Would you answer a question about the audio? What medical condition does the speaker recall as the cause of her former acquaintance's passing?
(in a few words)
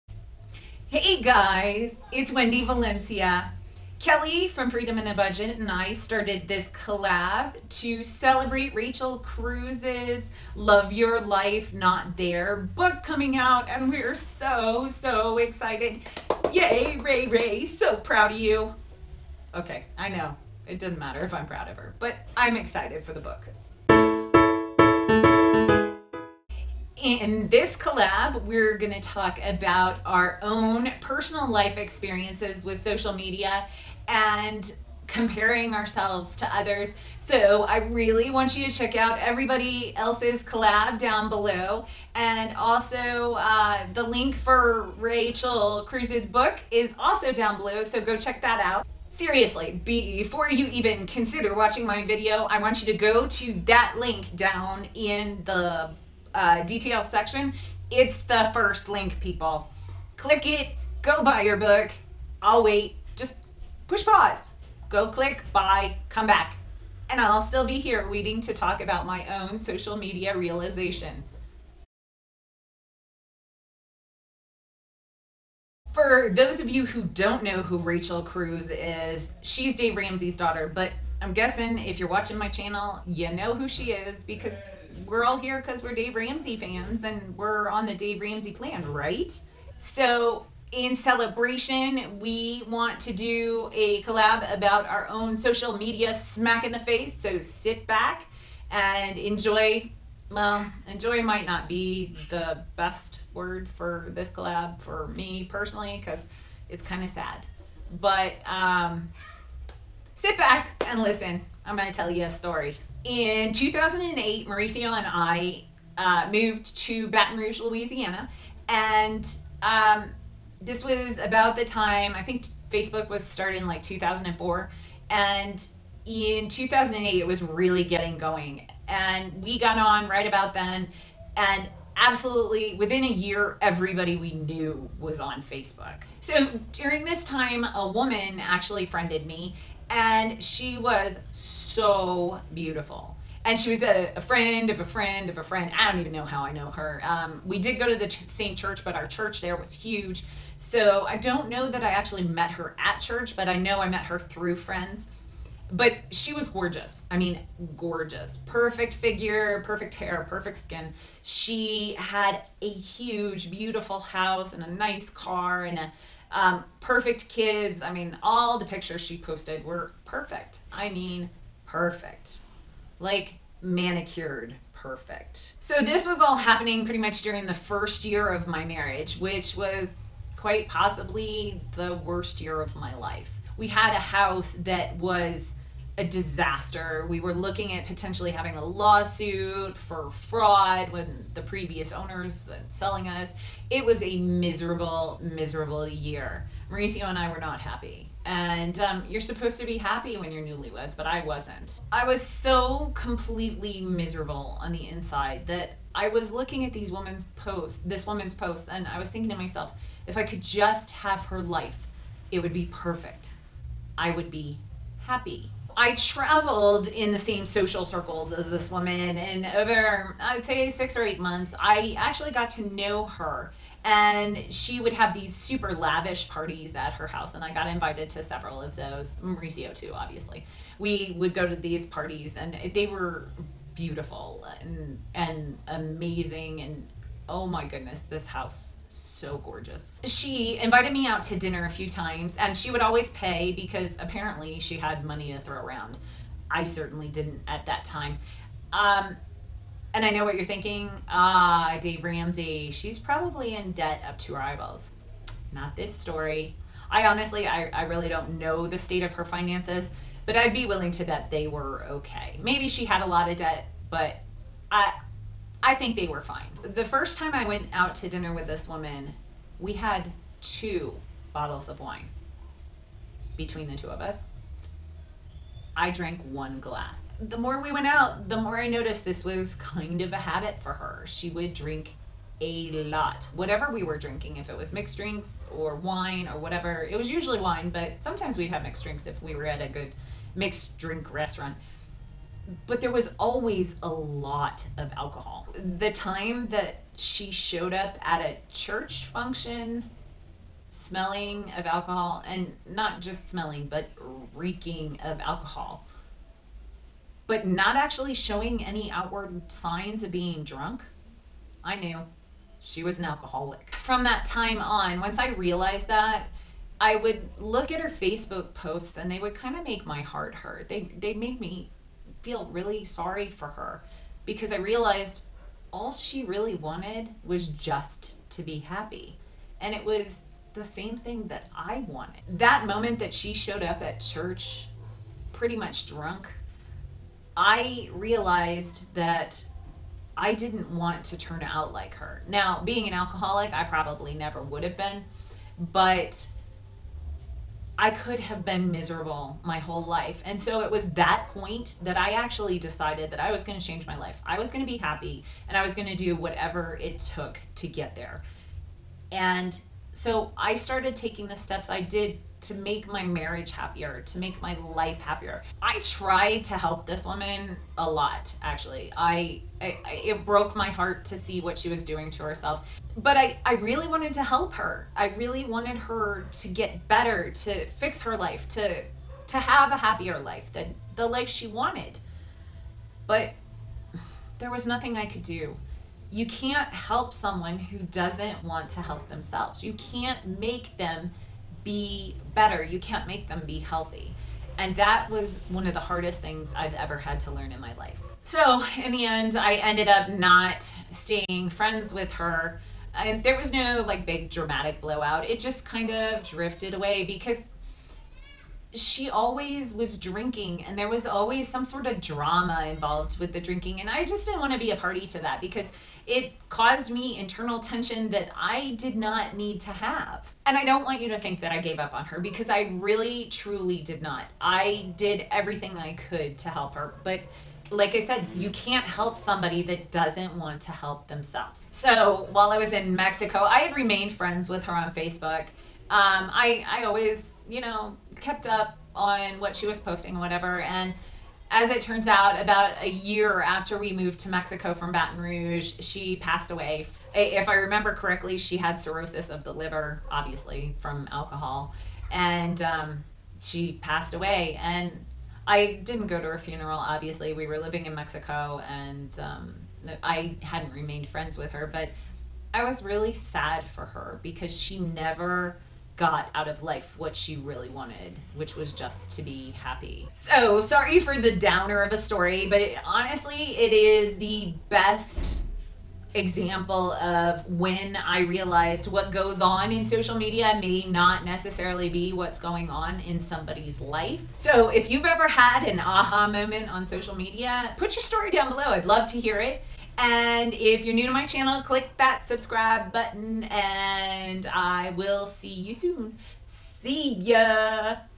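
Cirrhosis of the liver.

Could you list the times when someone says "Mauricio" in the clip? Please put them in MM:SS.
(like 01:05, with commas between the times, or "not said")
01:54, 03:16, 03:49.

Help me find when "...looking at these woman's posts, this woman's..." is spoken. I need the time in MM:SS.
03:26.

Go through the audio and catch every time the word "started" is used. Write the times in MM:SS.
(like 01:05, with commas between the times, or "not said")
00:05, 02:03, 06:00.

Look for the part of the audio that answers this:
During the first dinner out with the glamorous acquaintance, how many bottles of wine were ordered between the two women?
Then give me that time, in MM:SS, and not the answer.
04:30.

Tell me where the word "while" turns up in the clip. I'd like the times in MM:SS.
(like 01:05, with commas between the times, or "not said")
07:12.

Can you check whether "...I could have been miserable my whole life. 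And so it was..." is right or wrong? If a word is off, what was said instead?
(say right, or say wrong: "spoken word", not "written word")
right.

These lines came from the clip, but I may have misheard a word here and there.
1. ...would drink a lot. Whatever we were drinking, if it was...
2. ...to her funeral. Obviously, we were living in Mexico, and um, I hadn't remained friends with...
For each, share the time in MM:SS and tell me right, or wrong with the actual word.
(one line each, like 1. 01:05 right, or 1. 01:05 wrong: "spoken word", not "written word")
1. 04:41 right
2. 07:36 right.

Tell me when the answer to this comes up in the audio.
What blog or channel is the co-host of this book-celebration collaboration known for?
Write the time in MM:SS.
00:04.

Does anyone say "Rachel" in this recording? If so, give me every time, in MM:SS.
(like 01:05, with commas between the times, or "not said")
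00:08, 00:44, 01:17.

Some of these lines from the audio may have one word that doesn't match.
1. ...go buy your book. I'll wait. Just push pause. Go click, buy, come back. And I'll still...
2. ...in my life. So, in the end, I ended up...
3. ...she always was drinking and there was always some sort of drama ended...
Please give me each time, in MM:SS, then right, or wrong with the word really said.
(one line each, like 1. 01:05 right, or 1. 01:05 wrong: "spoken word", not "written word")
1. 01:01 right
2. 06:37 right
3. 06:48 wrong: "involved", not "ended".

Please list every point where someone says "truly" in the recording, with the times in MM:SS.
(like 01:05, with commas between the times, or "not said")
07:03.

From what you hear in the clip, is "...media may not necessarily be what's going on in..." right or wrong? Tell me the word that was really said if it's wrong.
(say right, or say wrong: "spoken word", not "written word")
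right.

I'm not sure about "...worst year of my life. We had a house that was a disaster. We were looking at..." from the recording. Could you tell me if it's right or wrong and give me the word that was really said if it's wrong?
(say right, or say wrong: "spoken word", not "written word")
right.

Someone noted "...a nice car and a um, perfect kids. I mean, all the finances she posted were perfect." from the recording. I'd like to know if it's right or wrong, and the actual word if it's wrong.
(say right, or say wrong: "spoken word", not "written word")
wrong: "pictures", not "finances".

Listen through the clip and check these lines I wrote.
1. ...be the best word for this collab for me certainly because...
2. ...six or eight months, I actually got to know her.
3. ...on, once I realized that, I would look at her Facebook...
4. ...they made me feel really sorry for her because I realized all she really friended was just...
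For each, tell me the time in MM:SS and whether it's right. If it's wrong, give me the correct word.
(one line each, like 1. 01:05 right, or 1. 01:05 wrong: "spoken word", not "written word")
1. 01:41 wrong: "personally", not "certainly"
2. 03:40 right
3. 05:14 right
4. 05:20 wrong: "wanted", not "friended".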